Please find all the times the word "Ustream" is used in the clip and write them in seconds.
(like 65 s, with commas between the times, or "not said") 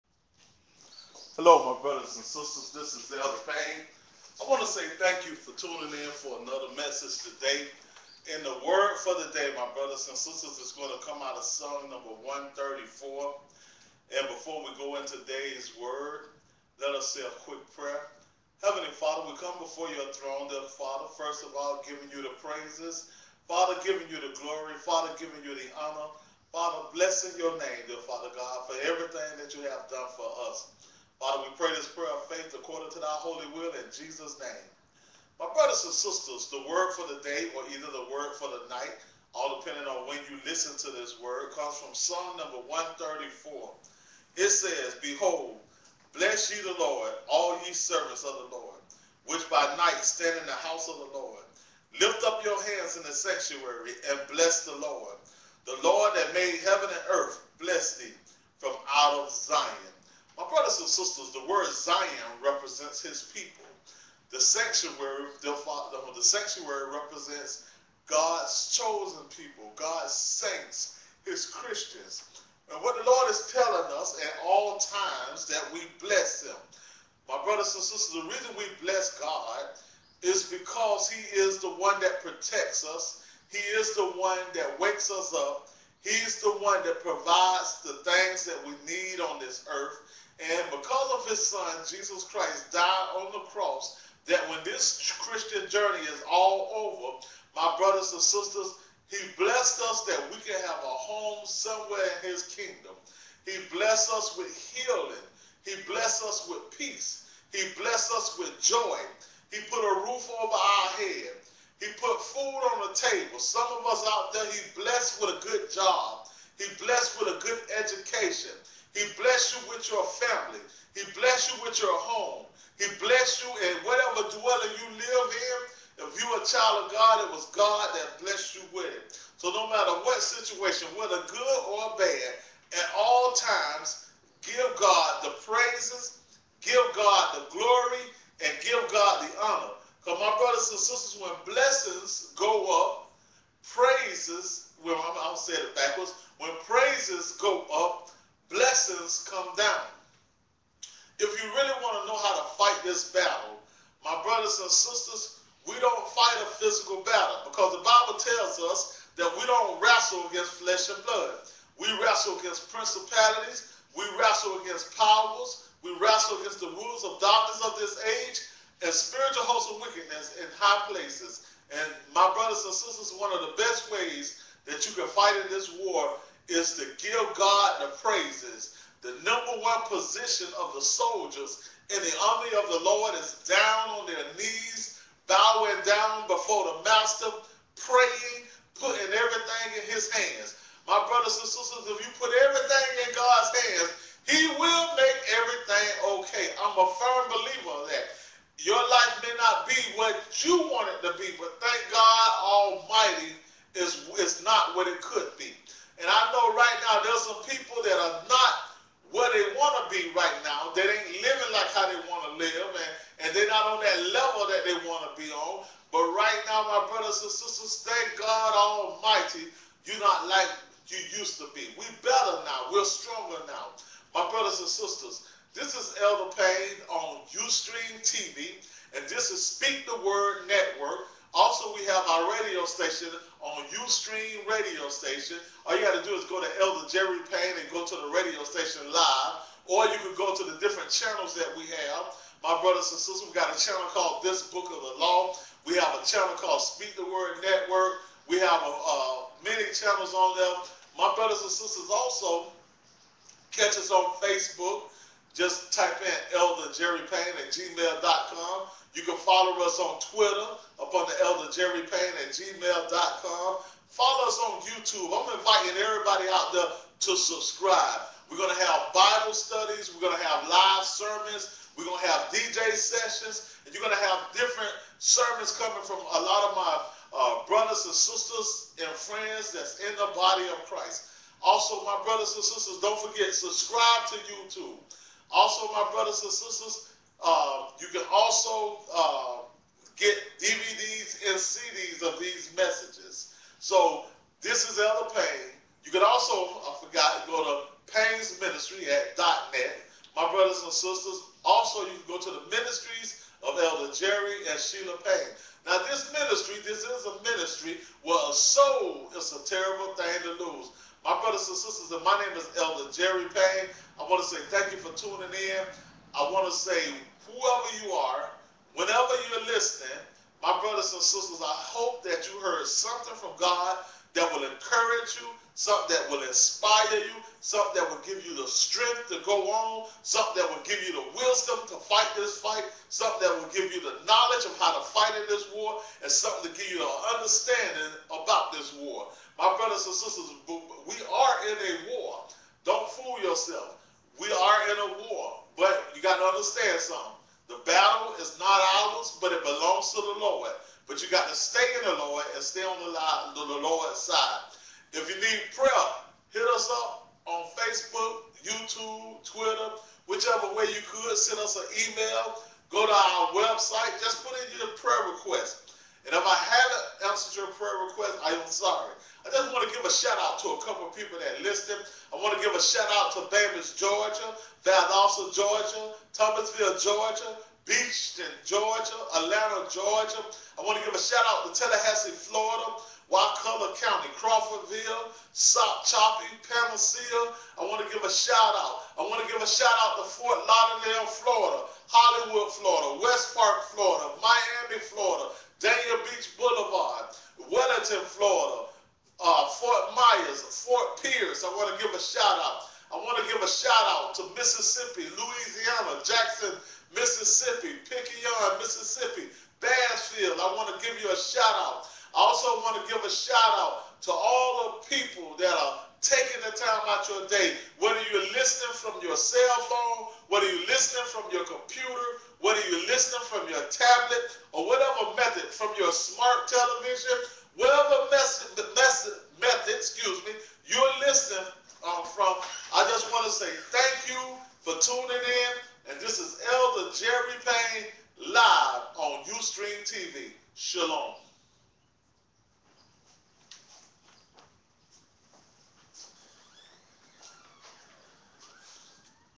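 227 s, 233 s, 439 s.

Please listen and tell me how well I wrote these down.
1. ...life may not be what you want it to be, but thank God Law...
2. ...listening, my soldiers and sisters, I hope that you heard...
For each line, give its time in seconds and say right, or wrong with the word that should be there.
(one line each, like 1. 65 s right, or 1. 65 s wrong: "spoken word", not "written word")
1. 198 s wrong: "Almighty", not "Law"
2. 319 s wrong: "brothers", not "soldiers".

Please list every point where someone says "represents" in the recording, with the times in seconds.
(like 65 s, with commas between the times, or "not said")
62 s, 66 s.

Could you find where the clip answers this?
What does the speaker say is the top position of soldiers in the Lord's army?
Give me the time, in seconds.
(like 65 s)
183 s.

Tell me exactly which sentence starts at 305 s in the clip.
Now this ministry, this is a ministry where a soul is a terrible thing to lose.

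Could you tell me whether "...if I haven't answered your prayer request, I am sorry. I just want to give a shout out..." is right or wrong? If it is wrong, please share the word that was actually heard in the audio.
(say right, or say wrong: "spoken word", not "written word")
right.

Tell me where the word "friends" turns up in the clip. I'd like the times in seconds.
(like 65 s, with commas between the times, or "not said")
278 s.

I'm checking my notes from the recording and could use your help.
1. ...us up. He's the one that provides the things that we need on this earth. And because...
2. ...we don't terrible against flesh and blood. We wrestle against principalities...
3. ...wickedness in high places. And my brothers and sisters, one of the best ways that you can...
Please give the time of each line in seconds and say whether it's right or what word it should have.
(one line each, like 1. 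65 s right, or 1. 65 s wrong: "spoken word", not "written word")
1. 85 s right
2. 159 s wrong: "wrestle", not "terrible"
3. 169 s right.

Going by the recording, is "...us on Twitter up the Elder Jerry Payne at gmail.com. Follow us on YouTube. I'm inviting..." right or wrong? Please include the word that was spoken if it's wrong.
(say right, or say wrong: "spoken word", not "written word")
right.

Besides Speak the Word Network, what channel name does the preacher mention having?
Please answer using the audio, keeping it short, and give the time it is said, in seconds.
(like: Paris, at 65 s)
This Book of the Law, at 244 s.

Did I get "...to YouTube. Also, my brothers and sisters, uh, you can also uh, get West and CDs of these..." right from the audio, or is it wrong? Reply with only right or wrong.
wrong.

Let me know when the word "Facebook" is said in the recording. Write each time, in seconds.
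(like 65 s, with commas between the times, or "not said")
254 s, 357 s.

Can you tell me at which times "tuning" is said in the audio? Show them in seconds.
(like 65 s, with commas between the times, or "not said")
5 s, 314 s, 434 s.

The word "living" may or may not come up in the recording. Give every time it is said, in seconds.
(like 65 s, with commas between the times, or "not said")
211 s.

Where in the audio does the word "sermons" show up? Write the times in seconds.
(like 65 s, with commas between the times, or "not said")
270 s, 274 s.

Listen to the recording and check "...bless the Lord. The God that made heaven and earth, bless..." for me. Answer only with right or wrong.
wrong.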